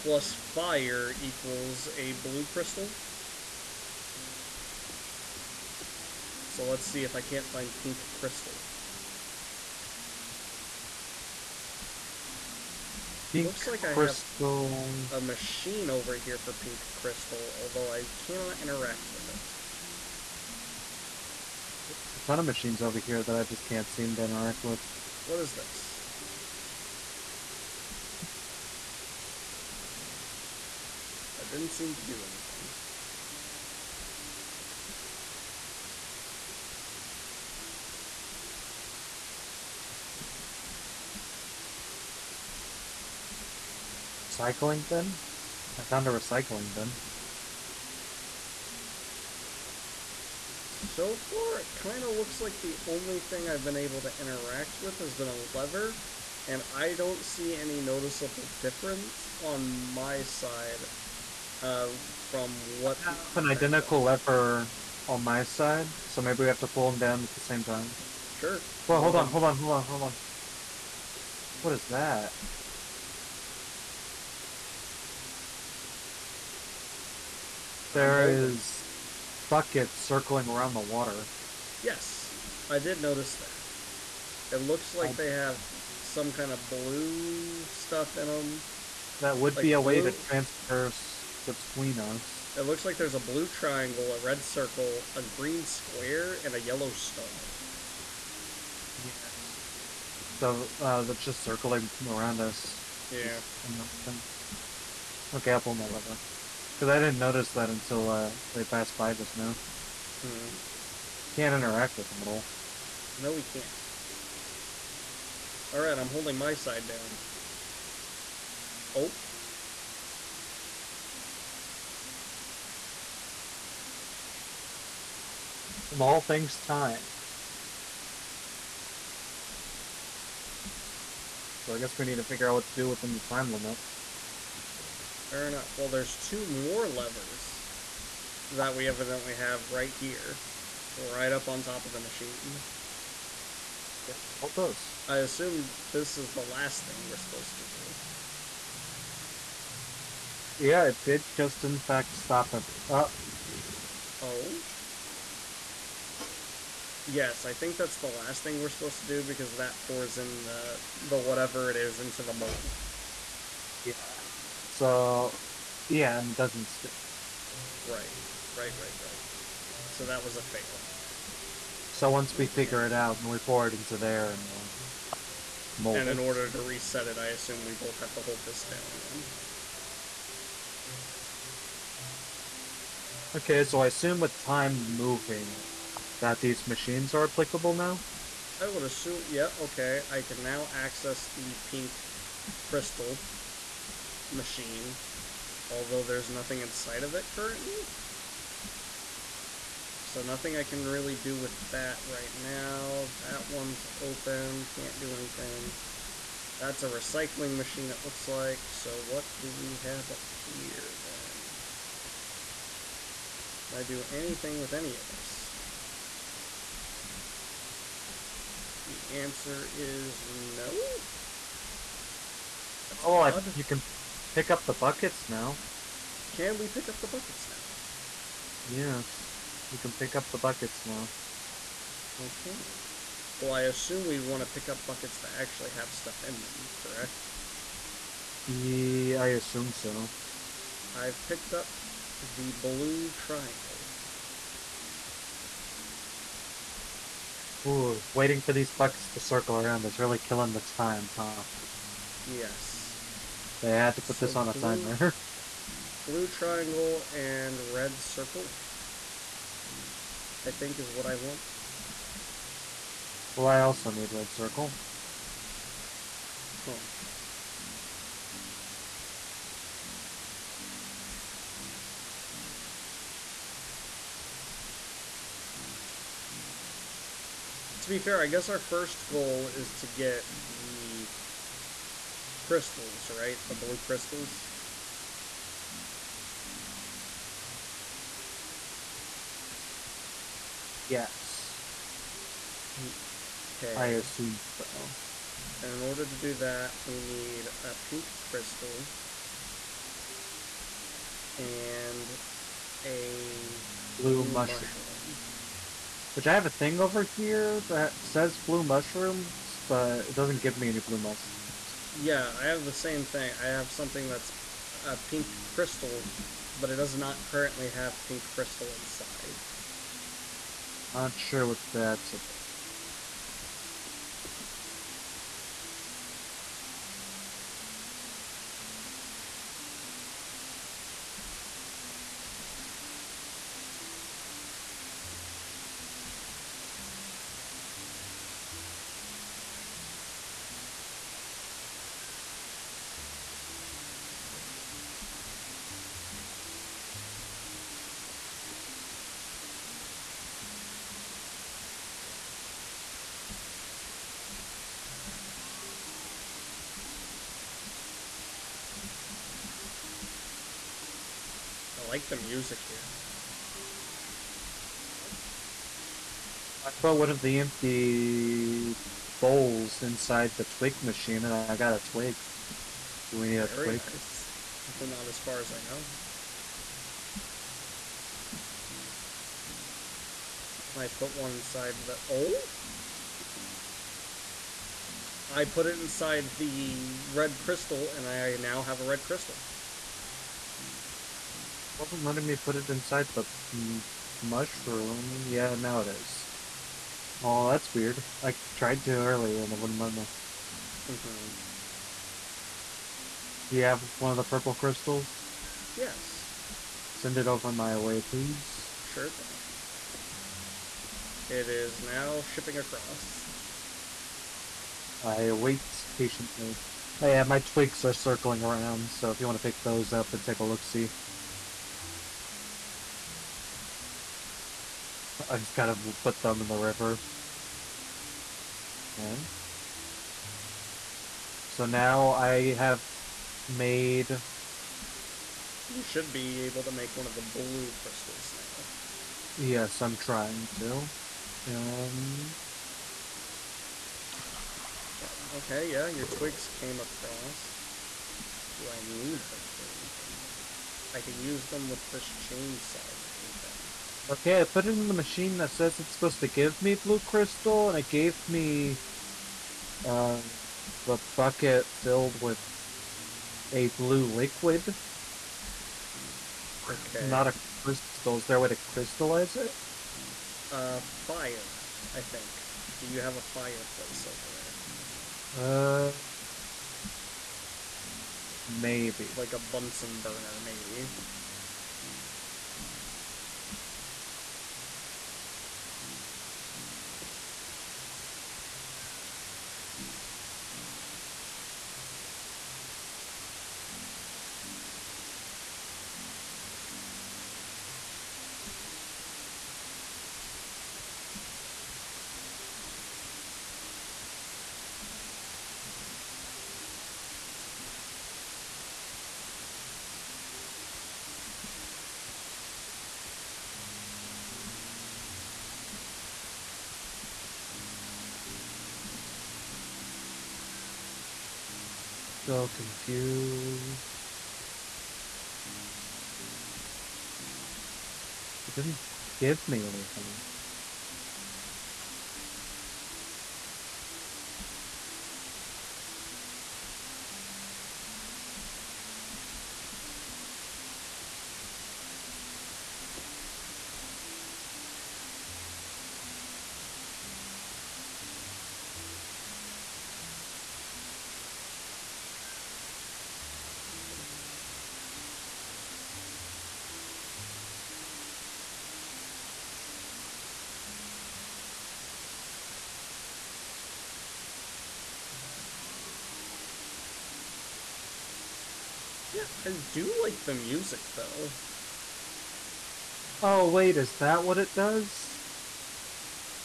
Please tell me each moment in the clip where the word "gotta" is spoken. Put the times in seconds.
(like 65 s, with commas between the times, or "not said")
425 s.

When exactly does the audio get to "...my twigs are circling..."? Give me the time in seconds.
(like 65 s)
417 s.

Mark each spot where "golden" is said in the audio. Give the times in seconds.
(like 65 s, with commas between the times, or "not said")
not said.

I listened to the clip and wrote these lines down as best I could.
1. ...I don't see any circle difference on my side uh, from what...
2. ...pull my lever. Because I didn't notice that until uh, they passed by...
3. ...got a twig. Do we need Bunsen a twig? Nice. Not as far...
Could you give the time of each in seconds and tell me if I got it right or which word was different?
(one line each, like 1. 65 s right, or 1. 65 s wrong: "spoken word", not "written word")
1. 56 s wrong: "noticeable", not "circle"
2. 105 s right
3. 371 s wrong: "Very", not "Bunsen".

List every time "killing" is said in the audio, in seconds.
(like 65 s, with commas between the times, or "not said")
250 s.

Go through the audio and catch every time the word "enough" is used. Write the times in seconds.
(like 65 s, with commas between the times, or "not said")
135 s.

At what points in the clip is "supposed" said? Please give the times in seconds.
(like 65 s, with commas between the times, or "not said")
147 s, 158 s, 455 s.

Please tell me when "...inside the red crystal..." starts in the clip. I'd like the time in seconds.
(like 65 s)
385 s.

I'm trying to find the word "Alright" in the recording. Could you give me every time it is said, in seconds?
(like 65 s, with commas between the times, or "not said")
115 s.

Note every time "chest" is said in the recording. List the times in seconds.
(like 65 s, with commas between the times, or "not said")
not said.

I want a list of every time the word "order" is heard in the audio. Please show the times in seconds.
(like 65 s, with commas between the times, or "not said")
176 s, 295 s.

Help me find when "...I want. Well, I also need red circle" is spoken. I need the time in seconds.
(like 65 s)
261 s.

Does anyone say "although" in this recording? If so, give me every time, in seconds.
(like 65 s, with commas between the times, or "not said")
17 s, 195 s.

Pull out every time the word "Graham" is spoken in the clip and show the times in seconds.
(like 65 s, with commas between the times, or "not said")
not said.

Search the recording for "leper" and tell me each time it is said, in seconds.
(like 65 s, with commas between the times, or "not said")
64 s.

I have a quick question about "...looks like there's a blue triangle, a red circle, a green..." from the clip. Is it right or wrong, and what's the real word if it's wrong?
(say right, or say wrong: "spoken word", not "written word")
right.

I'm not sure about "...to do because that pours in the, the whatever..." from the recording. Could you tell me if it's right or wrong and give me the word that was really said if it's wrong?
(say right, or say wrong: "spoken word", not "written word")
right.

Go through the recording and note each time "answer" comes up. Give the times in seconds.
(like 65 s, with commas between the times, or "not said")
219 s.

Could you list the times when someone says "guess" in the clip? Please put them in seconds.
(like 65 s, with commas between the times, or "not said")
131 s, 278 s.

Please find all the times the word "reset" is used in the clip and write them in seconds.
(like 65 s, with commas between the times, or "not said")
176 s.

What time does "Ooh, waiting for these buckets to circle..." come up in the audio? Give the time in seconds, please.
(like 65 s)
247 s.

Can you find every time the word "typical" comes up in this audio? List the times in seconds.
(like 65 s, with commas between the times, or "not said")
not said.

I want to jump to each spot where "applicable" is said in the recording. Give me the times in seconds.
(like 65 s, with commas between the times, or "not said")
187 s.